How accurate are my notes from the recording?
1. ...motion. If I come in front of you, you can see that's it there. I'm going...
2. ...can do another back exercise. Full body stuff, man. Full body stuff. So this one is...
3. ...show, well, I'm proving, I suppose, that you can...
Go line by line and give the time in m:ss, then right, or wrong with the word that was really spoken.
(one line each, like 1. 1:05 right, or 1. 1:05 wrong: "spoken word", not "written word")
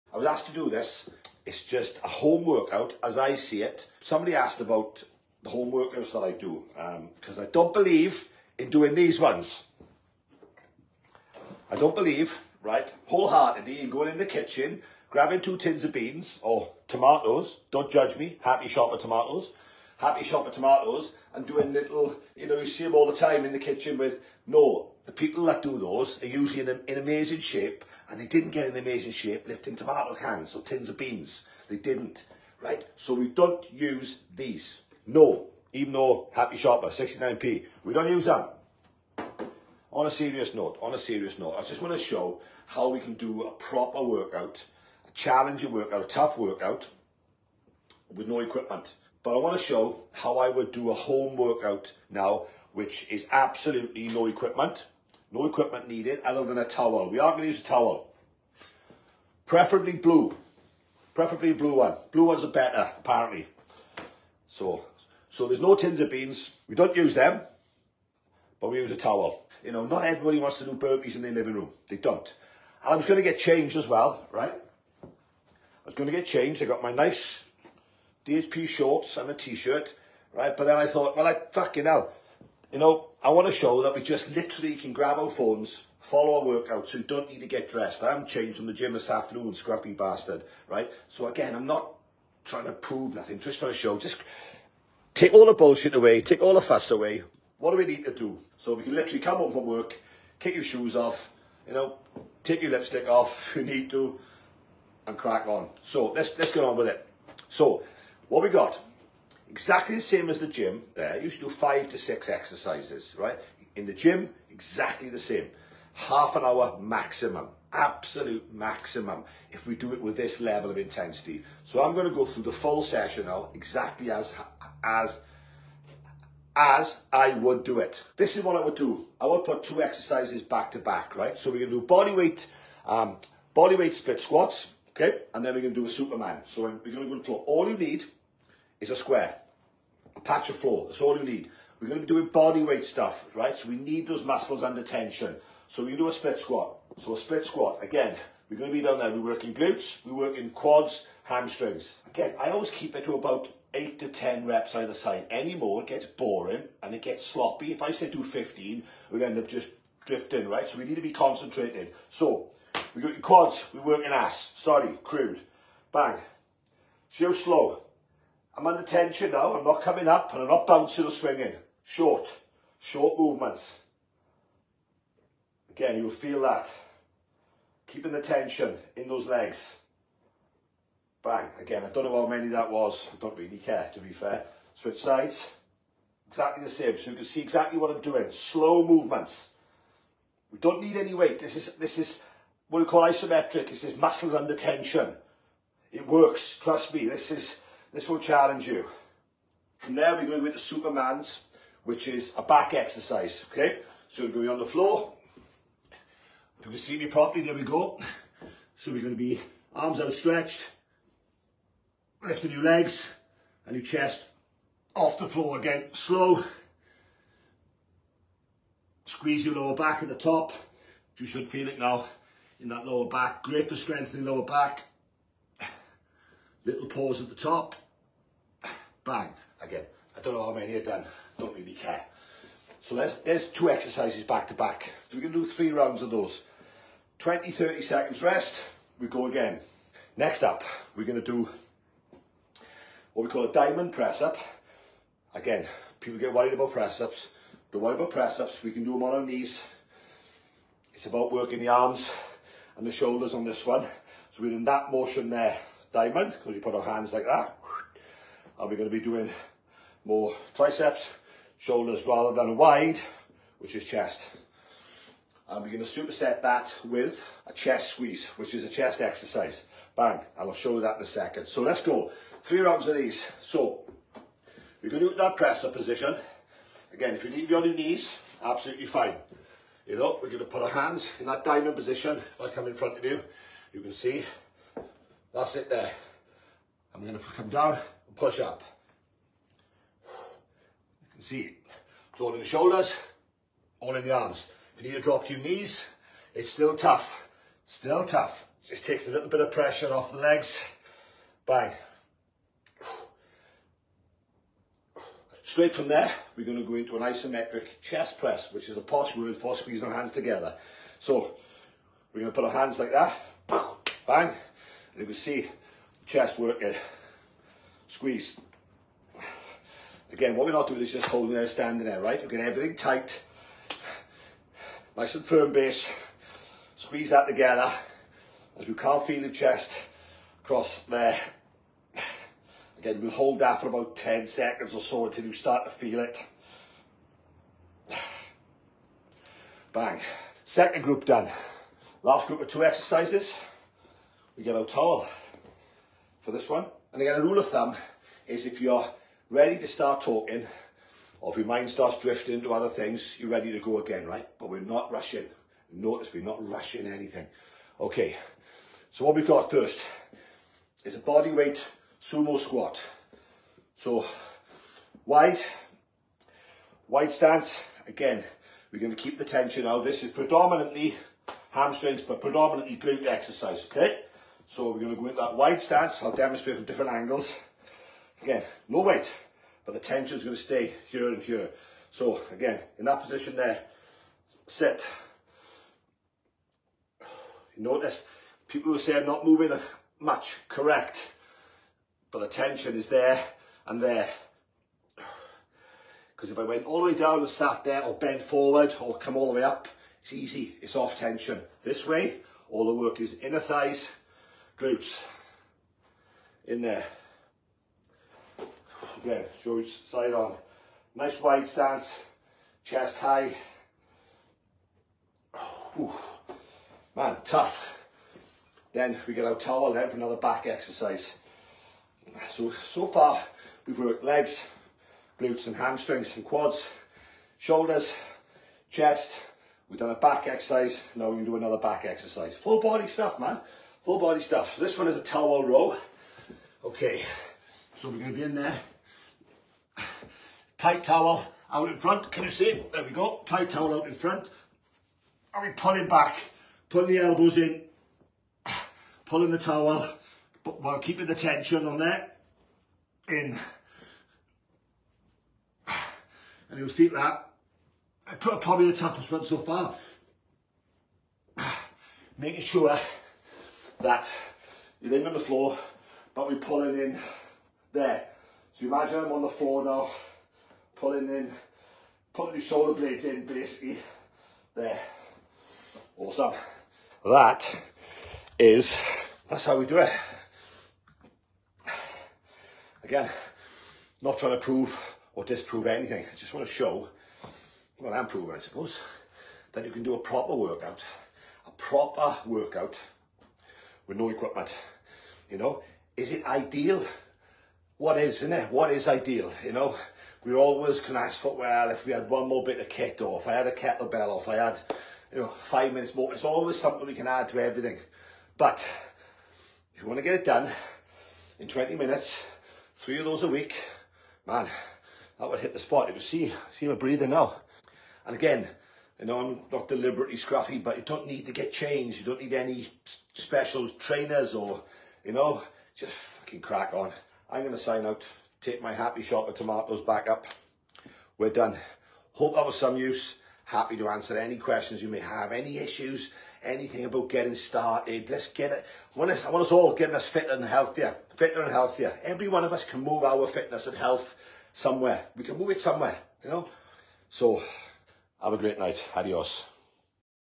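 1. 4:41 wrong: "position", not "motion"
2. 7:11 right
3. 8:06 right.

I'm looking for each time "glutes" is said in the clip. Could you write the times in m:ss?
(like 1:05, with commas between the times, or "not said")
2:29, 6:12, 6:44, 7:05.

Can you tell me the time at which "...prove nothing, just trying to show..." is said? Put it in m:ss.
1:32.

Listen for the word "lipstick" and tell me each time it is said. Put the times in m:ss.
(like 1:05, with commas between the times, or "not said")
1:42.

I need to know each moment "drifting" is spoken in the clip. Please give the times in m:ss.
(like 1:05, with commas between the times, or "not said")
2:40, 5:51.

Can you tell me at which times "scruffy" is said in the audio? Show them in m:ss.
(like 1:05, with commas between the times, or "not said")
1:29, 8:40.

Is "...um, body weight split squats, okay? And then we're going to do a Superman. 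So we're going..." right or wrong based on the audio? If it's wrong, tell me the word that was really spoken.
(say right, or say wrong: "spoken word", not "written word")
right.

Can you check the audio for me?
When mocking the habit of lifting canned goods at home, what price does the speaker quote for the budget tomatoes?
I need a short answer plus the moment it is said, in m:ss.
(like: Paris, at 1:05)
69p, at 0:36.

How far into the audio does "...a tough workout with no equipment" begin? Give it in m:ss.
0:46.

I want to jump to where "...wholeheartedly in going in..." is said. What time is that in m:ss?
0:13.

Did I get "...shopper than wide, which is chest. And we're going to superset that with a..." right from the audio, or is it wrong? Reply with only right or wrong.
wrong.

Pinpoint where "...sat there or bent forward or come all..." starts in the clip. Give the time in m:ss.
6:37.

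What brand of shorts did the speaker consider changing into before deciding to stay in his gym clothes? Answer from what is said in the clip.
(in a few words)
DHP.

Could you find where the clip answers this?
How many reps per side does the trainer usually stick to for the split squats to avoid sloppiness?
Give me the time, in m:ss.
2:33.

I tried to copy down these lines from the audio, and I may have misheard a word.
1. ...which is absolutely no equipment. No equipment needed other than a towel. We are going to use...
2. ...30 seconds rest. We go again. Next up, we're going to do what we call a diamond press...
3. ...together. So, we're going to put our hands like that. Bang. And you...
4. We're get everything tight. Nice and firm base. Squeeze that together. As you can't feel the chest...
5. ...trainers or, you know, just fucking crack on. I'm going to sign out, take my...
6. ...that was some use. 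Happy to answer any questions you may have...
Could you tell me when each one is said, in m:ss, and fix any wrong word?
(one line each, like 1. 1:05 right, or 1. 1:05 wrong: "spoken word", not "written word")
1. 0:52 right
2. 3:57 right
3. 5:10 right
4. 5:22 right
5. 8:43 right
6. 8:52 right.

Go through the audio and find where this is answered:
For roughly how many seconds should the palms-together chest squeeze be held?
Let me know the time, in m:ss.
5:33.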